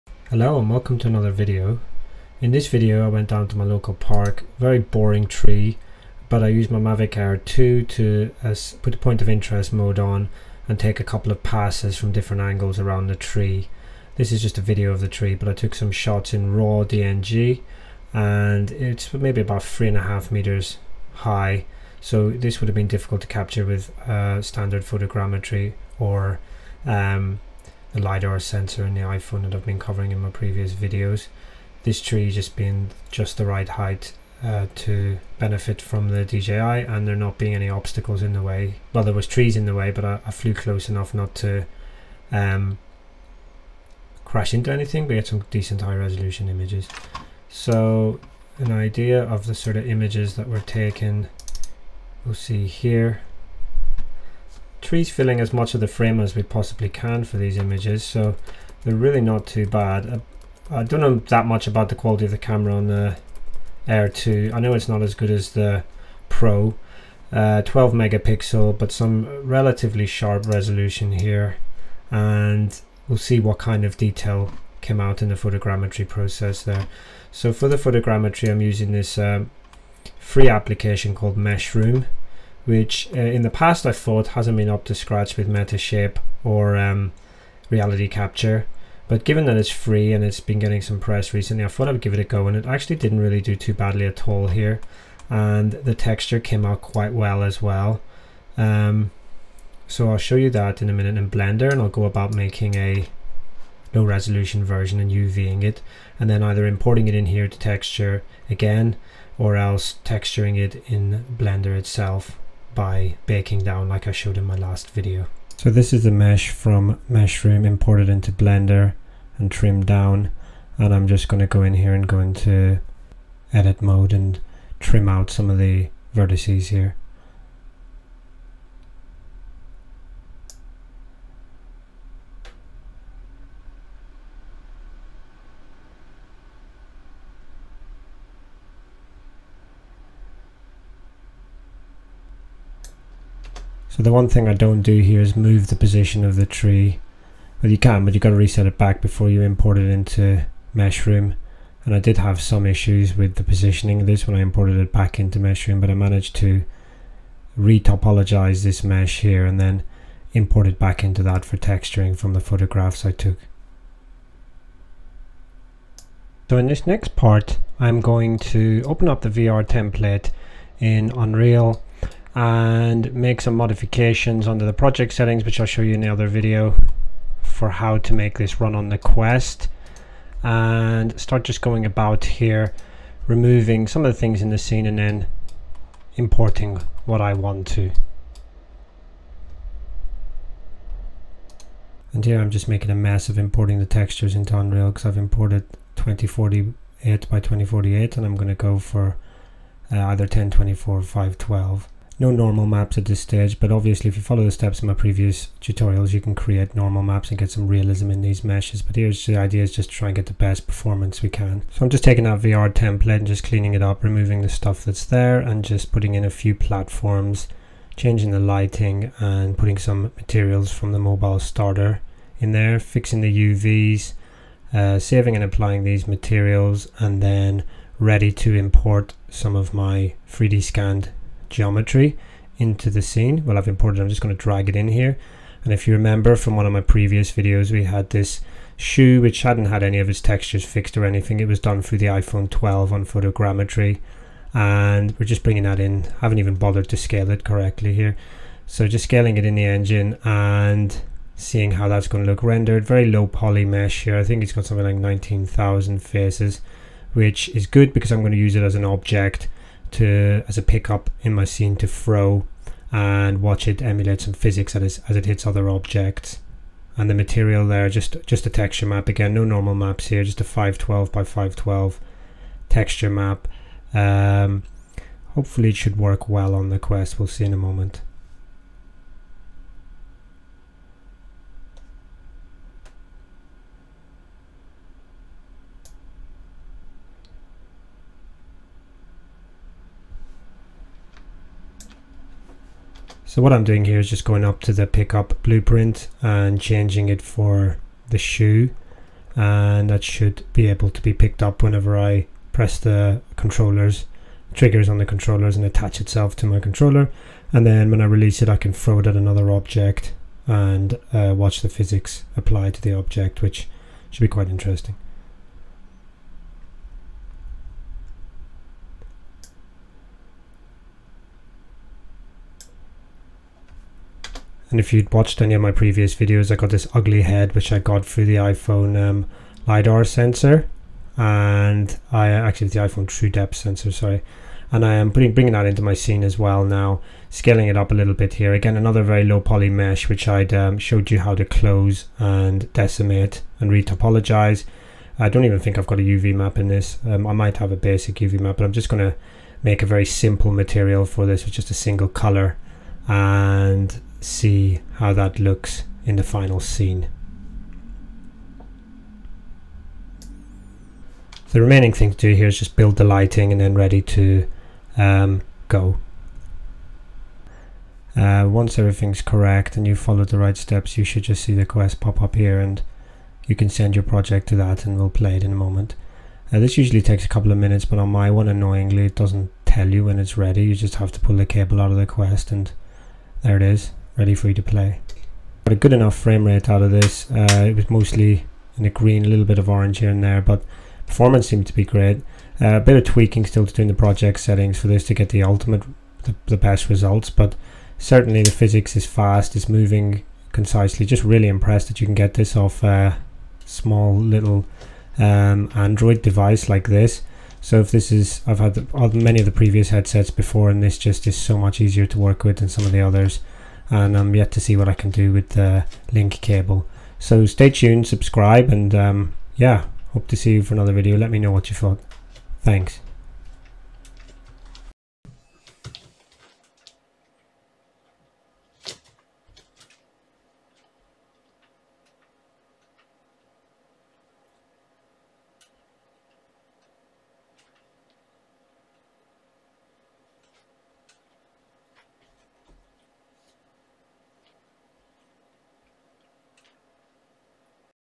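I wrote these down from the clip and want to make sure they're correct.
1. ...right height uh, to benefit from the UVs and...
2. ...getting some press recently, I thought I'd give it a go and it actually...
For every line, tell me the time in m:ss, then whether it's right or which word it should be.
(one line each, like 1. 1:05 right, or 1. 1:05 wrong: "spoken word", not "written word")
1. 0:33 wrong: "DJI", not "UVs"
2. 1:30 right.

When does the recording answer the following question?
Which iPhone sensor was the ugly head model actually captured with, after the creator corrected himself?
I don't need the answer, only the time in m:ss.
5:33.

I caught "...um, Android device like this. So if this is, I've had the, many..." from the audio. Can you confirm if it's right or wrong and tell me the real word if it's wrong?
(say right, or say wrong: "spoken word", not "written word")
right.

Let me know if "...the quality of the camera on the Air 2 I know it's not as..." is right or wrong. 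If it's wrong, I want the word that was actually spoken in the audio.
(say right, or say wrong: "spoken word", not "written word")
right.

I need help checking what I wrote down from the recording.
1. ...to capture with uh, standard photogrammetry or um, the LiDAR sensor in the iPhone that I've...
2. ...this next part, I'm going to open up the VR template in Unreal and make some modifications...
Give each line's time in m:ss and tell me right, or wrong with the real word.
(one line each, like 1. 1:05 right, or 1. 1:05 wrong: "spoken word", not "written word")
1. 0:23 right
2. 2:46 right.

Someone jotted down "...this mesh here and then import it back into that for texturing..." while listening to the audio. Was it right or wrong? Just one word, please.
right.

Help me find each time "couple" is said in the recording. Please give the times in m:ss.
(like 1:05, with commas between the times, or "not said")
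0:11, 6:17.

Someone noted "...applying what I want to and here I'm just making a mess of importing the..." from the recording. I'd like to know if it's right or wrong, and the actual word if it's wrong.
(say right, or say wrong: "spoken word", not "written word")
wrong: "importing", not "applying".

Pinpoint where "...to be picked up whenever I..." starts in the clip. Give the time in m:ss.
5:00.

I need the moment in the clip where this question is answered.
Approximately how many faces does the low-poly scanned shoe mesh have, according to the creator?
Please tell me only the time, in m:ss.
4:14.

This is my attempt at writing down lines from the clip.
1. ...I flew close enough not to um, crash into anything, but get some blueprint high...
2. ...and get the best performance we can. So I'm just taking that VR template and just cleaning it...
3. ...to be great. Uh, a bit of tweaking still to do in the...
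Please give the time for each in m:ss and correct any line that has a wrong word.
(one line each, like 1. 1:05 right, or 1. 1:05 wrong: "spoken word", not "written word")
1. 0:40 wrong: "decent", not "blueprint"
2. 3:30 right
3. 6:31 right.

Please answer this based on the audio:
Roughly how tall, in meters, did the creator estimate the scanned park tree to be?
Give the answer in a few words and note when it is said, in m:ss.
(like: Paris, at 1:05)
3.5 meters, at 0:19.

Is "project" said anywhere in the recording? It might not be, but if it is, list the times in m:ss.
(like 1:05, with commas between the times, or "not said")
2:54, 6:14, 6:33.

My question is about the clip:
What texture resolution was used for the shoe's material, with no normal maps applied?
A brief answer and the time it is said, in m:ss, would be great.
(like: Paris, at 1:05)
512 by 512, at 4:30.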